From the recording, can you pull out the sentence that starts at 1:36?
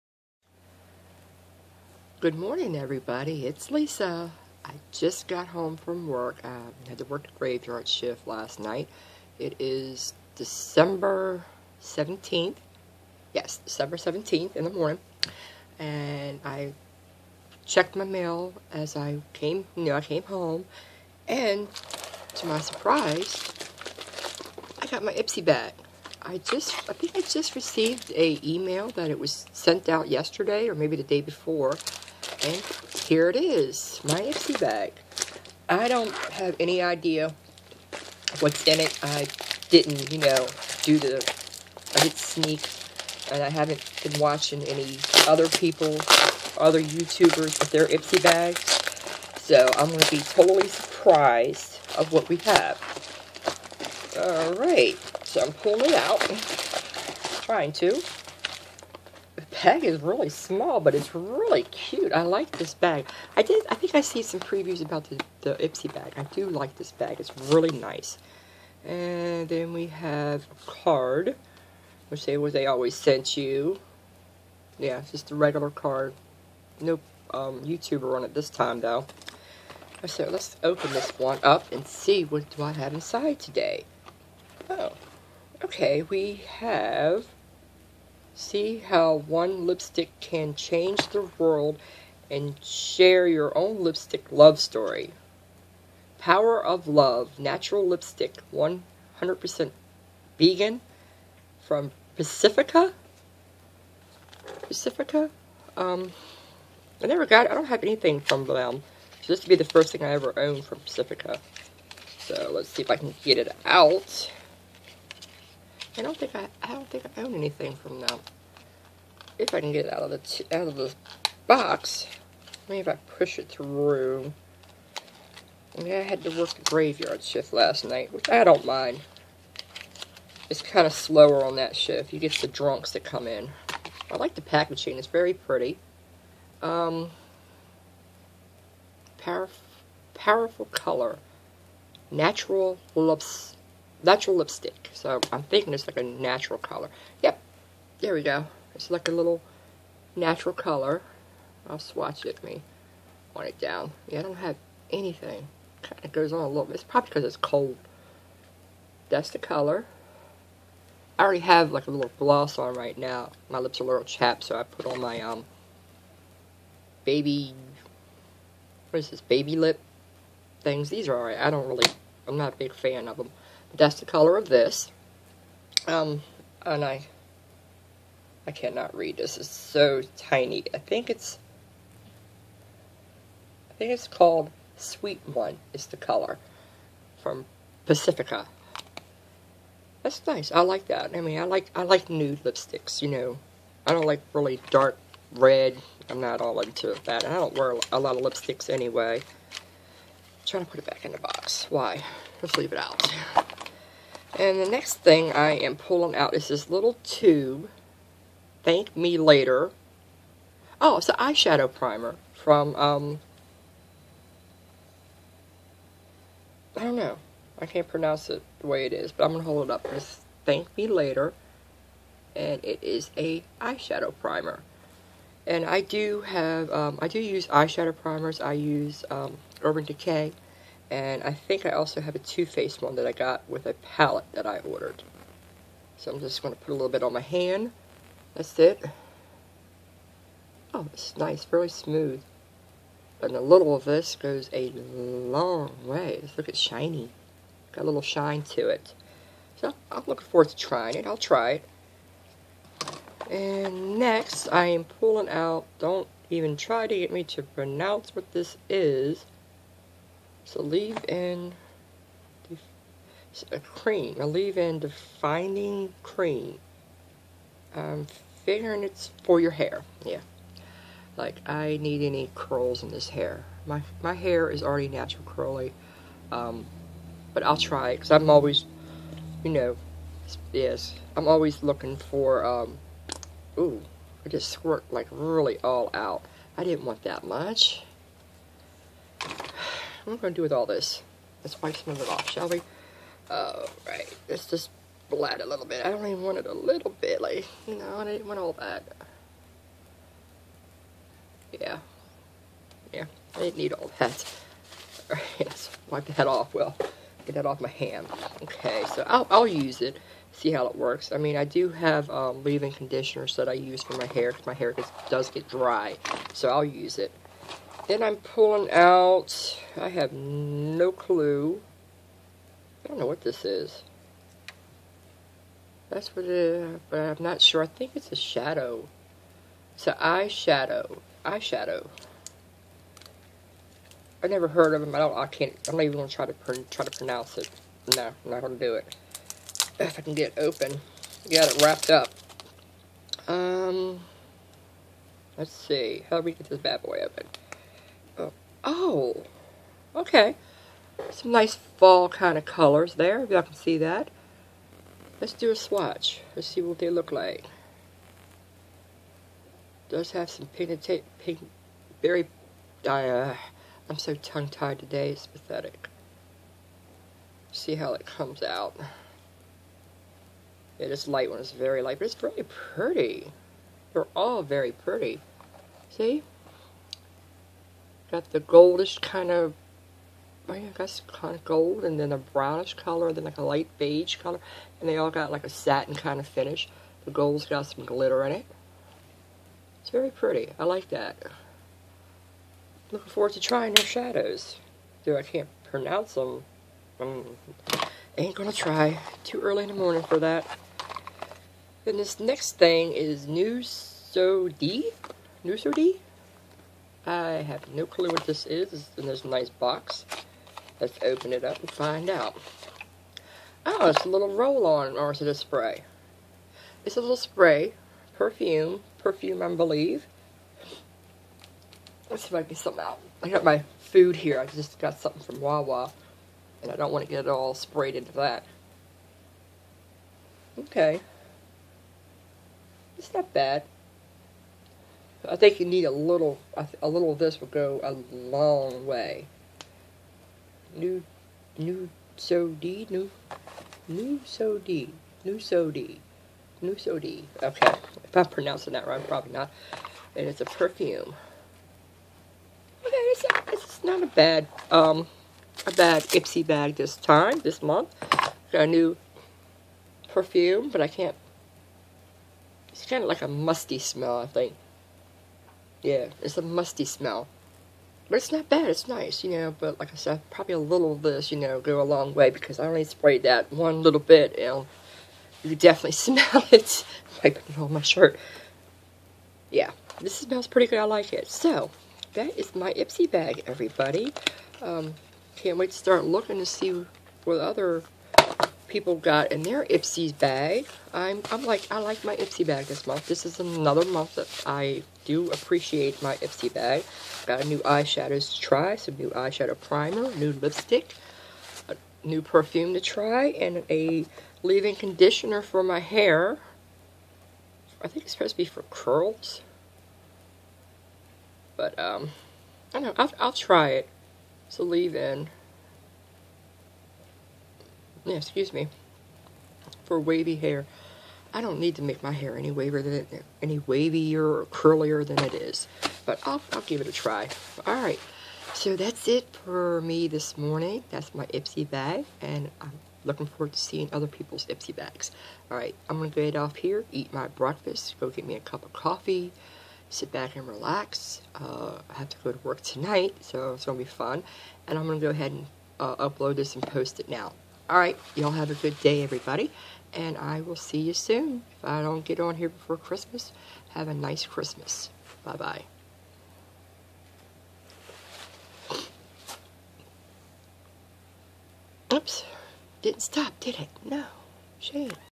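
Power of Love Natural Lipstick 100% Vegan from Pacifica.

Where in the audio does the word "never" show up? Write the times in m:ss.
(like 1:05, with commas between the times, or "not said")
1:47, 5:34.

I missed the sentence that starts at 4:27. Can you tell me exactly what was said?
I'm figuring it's for your hair, yeah.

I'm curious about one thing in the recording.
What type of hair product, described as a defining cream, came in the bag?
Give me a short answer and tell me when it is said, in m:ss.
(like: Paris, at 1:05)
leave-in defining cream, at 4:24.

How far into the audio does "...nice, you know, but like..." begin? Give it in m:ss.
7:48.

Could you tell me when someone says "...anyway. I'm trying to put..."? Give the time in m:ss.
3:18.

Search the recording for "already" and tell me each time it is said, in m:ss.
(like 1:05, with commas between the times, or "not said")
2:41, 4:34.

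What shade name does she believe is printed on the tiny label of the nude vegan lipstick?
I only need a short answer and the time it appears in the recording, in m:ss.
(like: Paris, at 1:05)
Sweet One, at 3:04.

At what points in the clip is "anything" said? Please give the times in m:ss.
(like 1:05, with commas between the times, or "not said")
1:47, 1:57, 2:34.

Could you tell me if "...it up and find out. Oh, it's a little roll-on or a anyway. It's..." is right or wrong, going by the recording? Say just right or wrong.
wrong.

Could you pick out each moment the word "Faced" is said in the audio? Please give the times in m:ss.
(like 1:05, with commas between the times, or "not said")
3:52.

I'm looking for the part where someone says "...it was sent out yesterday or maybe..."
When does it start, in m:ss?
0:29.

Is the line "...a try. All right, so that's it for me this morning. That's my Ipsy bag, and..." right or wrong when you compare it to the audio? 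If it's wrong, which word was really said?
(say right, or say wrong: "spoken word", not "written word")
right.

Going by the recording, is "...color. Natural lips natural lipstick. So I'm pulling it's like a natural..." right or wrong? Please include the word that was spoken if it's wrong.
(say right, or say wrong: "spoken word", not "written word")
wrong: "thinking", not "pulling".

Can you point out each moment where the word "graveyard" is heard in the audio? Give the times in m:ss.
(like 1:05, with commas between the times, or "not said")
0:07, 2:06.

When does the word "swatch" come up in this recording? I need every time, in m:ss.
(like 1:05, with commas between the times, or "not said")
2:31, 5:55.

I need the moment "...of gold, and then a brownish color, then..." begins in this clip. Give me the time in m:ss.
6:21.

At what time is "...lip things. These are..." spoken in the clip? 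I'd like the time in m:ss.
2:49.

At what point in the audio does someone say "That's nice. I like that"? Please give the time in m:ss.
3:10.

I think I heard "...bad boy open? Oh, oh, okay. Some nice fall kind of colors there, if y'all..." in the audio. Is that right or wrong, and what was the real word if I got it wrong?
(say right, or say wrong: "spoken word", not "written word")
right.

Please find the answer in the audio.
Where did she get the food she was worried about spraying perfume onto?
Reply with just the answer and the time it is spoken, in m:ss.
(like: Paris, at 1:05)
Wawa, at 7:05.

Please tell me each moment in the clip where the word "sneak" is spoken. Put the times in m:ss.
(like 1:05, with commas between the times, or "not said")
0:42.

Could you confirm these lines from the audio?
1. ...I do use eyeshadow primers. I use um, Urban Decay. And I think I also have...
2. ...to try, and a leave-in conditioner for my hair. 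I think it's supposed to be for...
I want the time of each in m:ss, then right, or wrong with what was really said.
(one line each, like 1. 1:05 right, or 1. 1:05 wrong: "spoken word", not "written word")
1. 3:46 right
2. 8:22 right.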